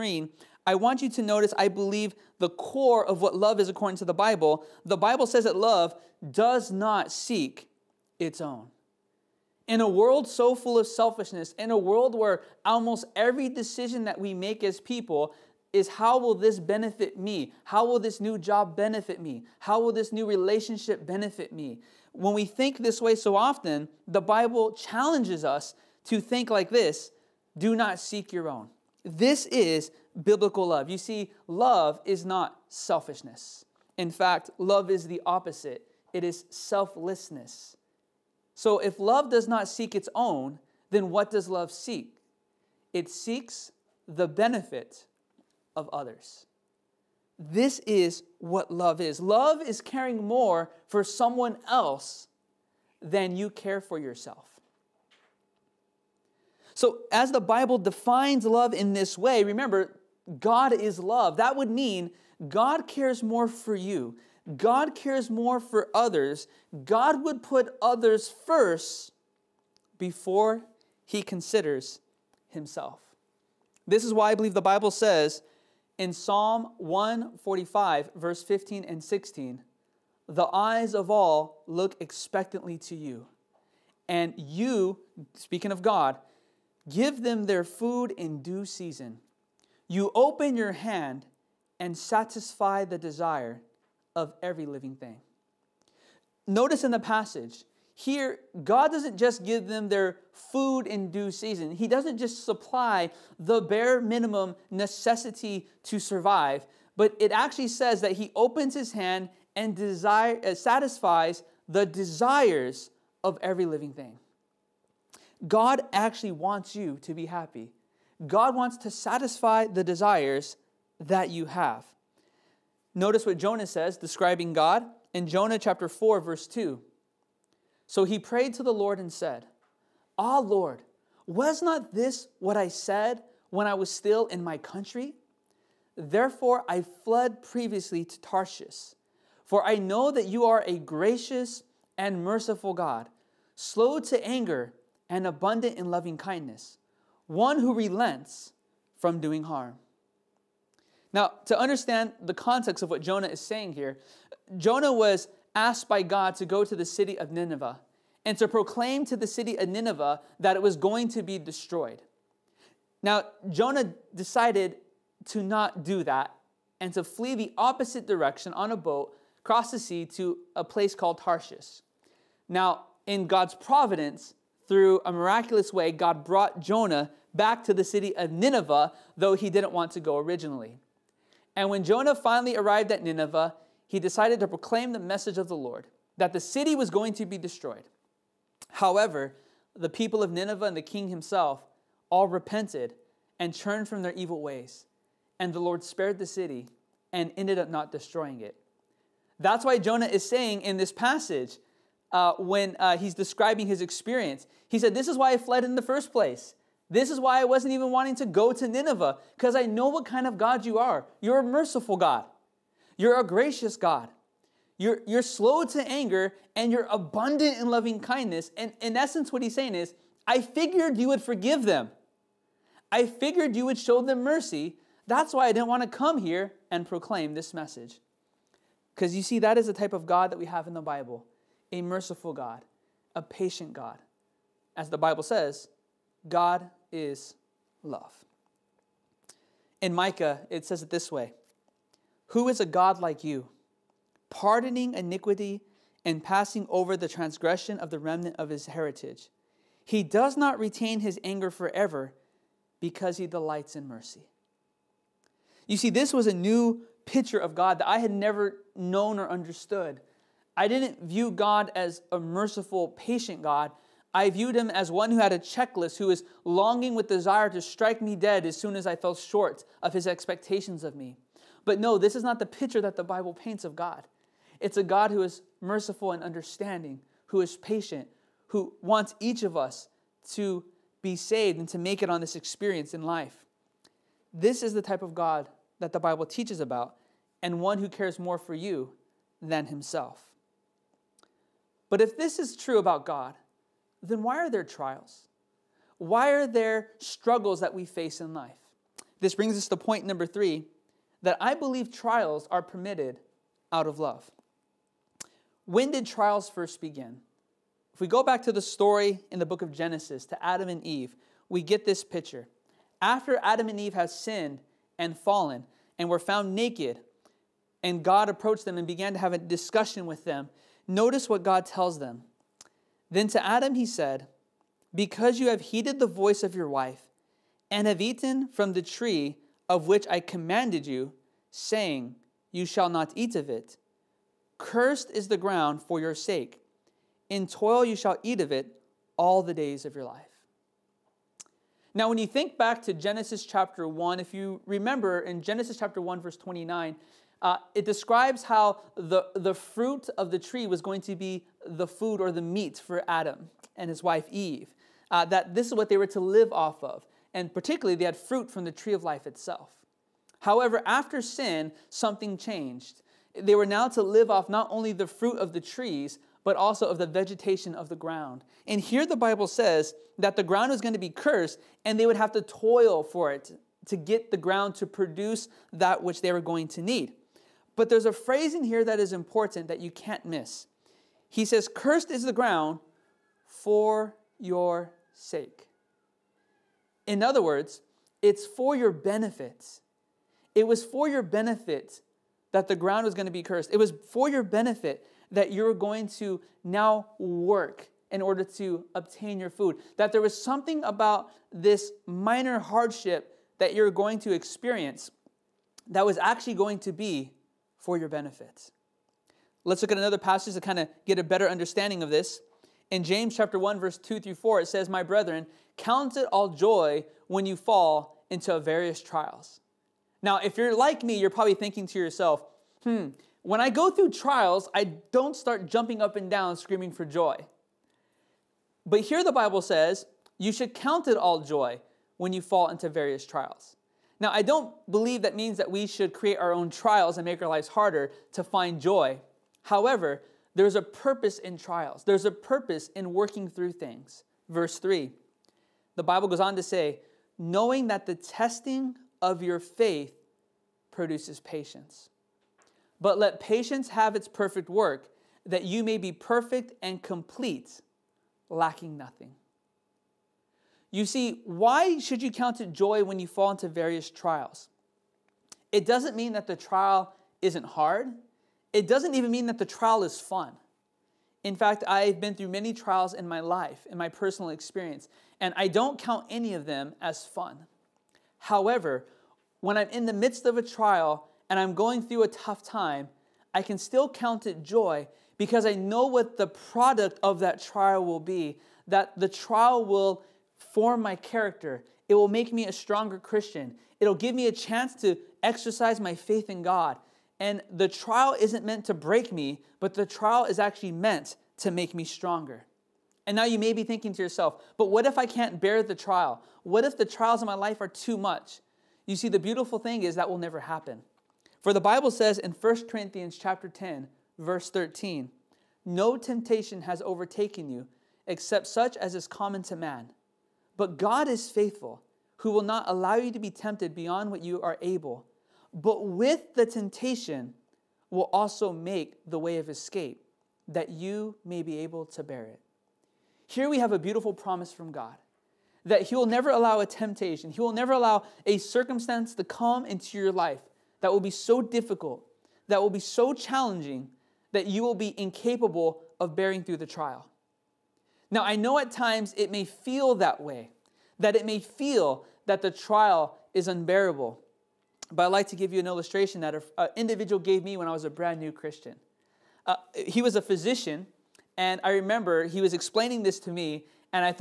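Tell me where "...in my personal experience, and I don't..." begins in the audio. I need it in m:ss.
7:53.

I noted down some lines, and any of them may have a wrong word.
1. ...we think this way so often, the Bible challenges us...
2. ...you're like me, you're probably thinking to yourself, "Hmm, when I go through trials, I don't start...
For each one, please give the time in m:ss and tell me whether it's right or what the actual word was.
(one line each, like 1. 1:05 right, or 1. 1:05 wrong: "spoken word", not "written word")
1. 0:22 right
2. 7:00 right.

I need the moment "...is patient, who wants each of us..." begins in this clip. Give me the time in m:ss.
4:37.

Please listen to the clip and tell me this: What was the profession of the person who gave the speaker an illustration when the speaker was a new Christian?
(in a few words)
physician.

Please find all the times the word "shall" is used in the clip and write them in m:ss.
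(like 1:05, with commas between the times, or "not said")
5:32, 5:37.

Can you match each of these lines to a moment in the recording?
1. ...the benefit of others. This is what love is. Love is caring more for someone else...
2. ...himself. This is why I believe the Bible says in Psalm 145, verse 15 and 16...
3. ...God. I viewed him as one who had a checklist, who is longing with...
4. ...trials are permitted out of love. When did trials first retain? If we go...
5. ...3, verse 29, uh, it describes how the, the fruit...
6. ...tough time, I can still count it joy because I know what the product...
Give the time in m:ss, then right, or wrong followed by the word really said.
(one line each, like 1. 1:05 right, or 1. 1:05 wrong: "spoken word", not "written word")
1. 0:44 right
2. 1:12 right
3. 4:23 right
4. 5:01 wrong: "begin", not "retain"
5. 5:45 wrong: "1", not "3"
6. 8:02 right.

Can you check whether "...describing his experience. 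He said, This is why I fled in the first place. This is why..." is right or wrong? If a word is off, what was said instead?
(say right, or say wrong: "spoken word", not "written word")
right.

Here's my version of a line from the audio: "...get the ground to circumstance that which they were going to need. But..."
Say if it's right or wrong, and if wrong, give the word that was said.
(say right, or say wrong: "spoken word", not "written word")
wrong: "produce", not "circumstance".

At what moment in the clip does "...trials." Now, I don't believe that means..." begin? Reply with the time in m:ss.
7:13.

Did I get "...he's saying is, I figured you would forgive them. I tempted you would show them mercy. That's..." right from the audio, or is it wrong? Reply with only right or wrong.
wrong.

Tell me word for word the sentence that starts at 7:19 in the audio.
However, there's a purpose in trials, there's a purpose in working through things.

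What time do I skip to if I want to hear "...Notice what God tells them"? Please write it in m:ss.
5:20.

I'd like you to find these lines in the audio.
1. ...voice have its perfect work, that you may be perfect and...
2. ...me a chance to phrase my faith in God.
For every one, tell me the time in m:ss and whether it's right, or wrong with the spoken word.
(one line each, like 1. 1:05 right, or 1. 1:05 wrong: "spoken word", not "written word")
1. 7:33 wrong: "patience", not "voice"
2. 8:14 wrong: "exercise", not "phrase".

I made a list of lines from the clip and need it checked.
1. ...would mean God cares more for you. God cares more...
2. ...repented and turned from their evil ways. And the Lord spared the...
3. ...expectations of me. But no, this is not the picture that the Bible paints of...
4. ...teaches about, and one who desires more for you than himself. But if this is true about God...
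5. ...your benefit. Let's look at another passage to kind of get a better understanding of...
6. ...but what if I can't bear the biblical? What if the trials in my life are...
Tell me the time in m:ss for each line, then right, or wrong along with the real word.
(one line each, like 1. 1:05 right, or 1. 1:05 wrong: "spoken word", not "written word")
1. 1:01 right
2. 3:12 right
3. 4:30 right
4. 4:46 wrong: "cares", not "desires"
5. 6:47 right
6. 8:24 wrong: "trial", not "biblical".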